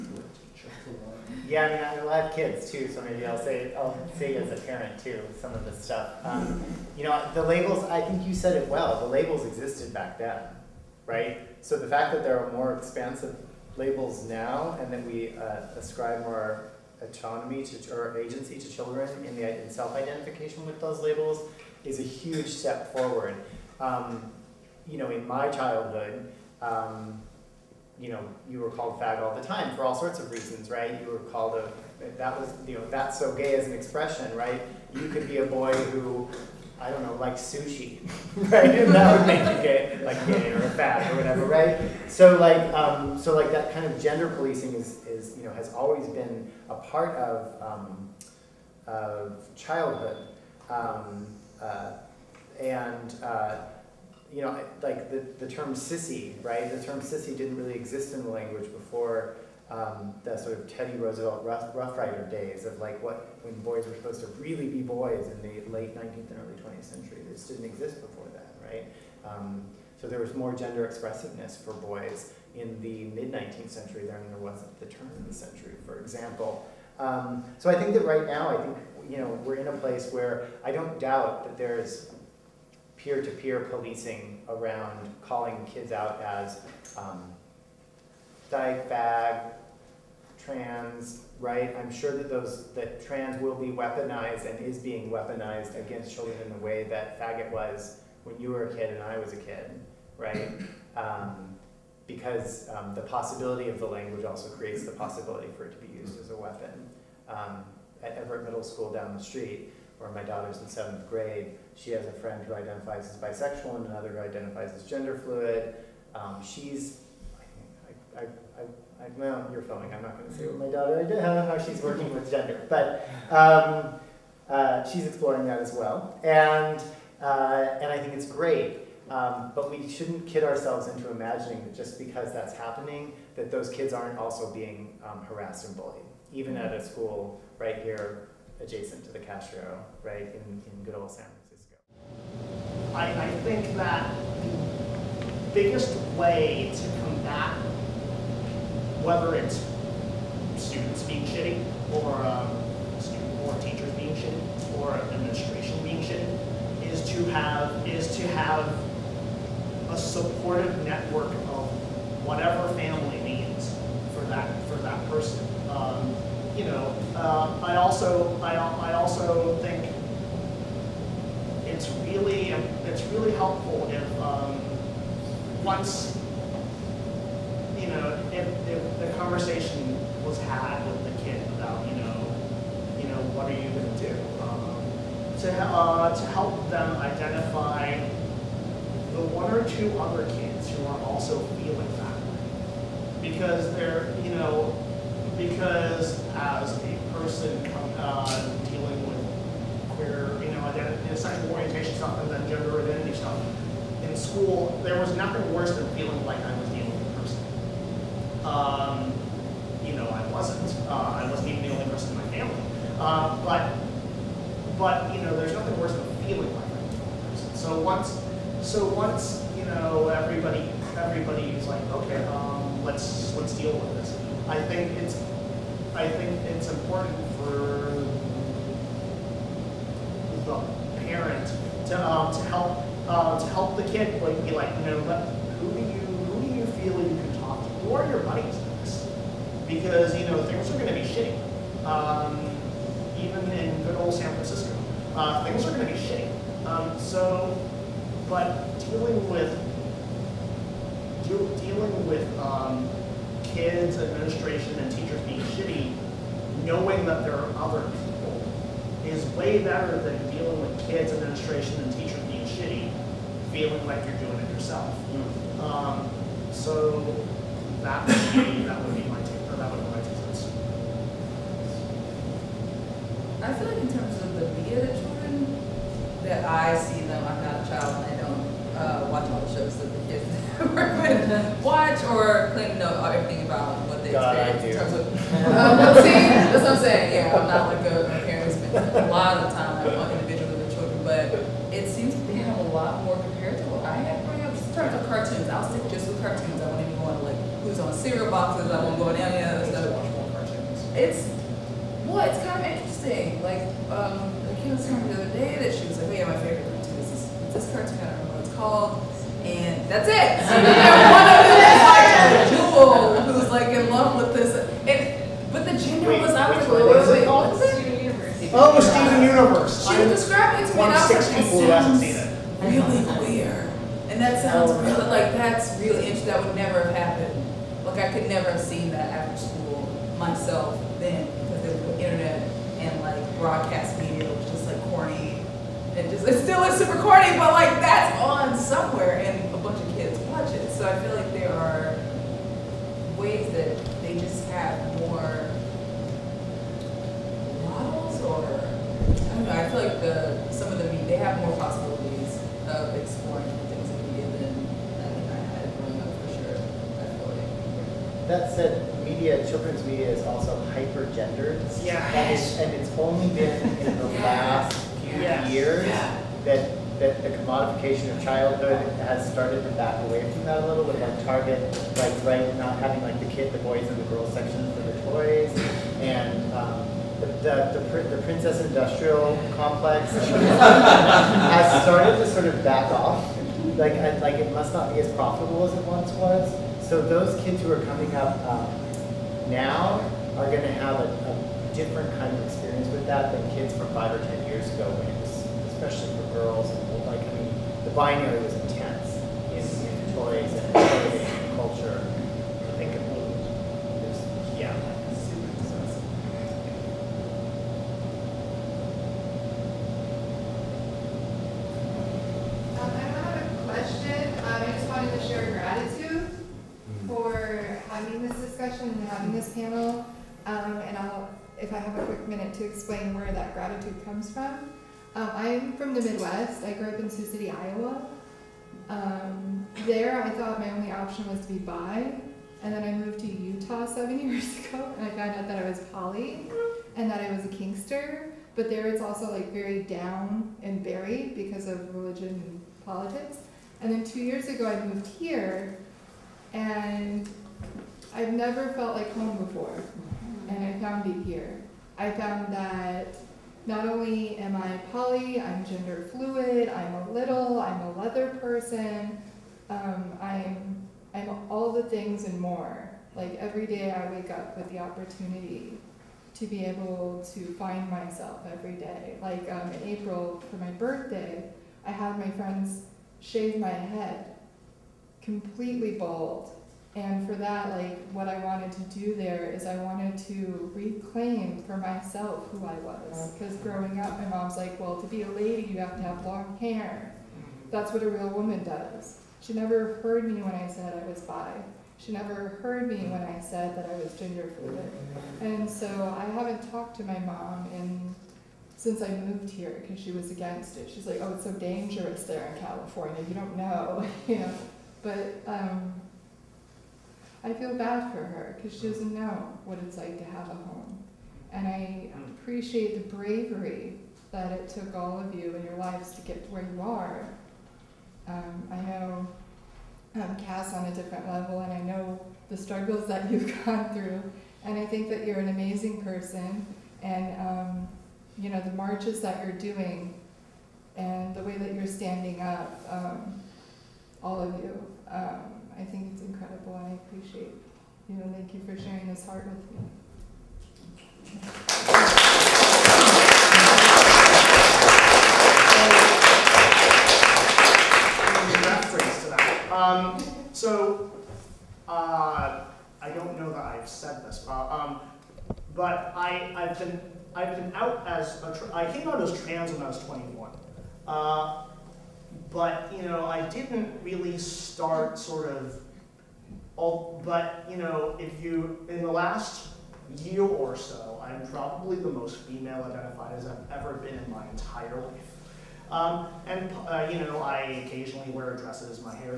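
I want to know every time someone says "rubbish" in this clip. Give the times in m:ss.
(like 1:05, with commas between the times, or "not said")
not said.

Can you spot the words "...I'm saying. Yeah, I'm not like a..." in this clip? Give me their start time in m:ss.
4:46.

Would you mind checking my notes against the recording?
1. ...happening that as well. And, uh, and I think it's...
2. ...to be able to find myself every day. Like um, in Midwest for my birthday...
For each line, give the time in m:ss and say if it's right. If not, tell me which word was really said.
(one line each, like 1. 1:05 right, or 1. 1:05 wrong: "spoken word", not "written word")
1. 2:05 wrong: "exploring", not "happening"
2. 7:46 wrong: "April", not "Midwest".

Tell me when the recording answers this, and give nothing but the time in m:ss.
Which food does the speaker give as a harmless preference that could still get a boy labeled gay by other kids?
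0:37.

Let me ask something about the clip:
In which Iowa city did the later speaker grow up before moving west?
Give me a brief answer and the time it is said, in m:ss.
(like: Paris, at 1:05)
Sioux City, at 7:07.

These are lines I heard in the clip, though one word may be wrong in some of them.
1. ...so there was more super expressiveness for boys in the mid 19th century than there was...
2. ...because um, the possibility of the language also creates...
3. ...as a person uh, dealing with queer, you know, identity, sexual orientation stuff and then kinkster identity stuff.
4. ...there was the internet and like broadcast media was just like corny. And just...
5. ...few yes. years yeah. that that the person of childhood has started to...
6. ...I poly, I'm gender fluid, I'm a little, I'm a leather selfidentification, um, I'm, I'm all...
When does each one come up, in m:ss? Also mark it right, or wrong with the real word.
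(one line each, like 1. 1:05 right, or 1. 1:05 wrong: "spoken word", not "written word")
1. 1:10 wrong: "gender", not "super"
2. 1:42 right
3. 3:16 wrong: "gender", not "kinkster"
4. 5:31 right
5. 6:05 wrong: "commodification", not "person"
6. 7:34 wrong: "person", not "selfidentification".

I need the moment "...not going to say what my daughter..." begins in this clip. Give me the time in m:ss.
2:00.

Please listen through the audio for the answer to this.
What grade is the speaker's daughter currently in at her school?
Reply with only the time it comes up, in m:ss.
1:50.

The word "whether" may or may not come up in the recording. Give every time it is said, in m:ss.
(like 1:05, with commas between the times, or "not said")
2:29.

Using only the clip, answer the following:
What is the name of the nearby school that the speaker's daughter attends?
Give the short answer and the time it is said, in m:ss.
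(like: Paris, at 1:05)
Everett Middle School, at 1:48.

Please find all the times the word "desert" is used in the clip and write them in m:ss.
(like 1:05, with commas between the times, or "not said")
not said.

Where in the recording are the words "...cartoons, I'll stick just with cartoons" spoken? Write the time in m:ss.
4:55.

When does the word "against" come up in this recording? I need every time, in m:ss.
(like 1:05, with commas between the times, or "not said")
1:35, 8:20.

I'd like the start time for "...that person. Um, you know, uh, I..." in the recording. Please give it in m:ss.
2:44.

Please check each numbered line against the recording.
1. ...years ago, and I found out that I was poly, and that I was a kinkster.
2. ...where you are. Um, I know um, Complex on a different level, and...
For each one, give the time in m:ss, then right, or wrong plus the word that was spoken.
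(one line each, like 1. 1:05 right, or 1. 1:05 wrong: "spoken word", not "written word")
1. 7:14 right
2. 8:36 wrong: "Cass", not "Complex".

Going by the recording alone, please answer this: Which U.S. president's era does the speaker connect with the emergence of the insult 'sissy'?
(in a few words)
Teddy Roosevelt.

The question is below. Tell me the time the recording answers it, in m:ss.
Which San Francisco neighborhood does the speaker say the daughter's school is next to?
2:19.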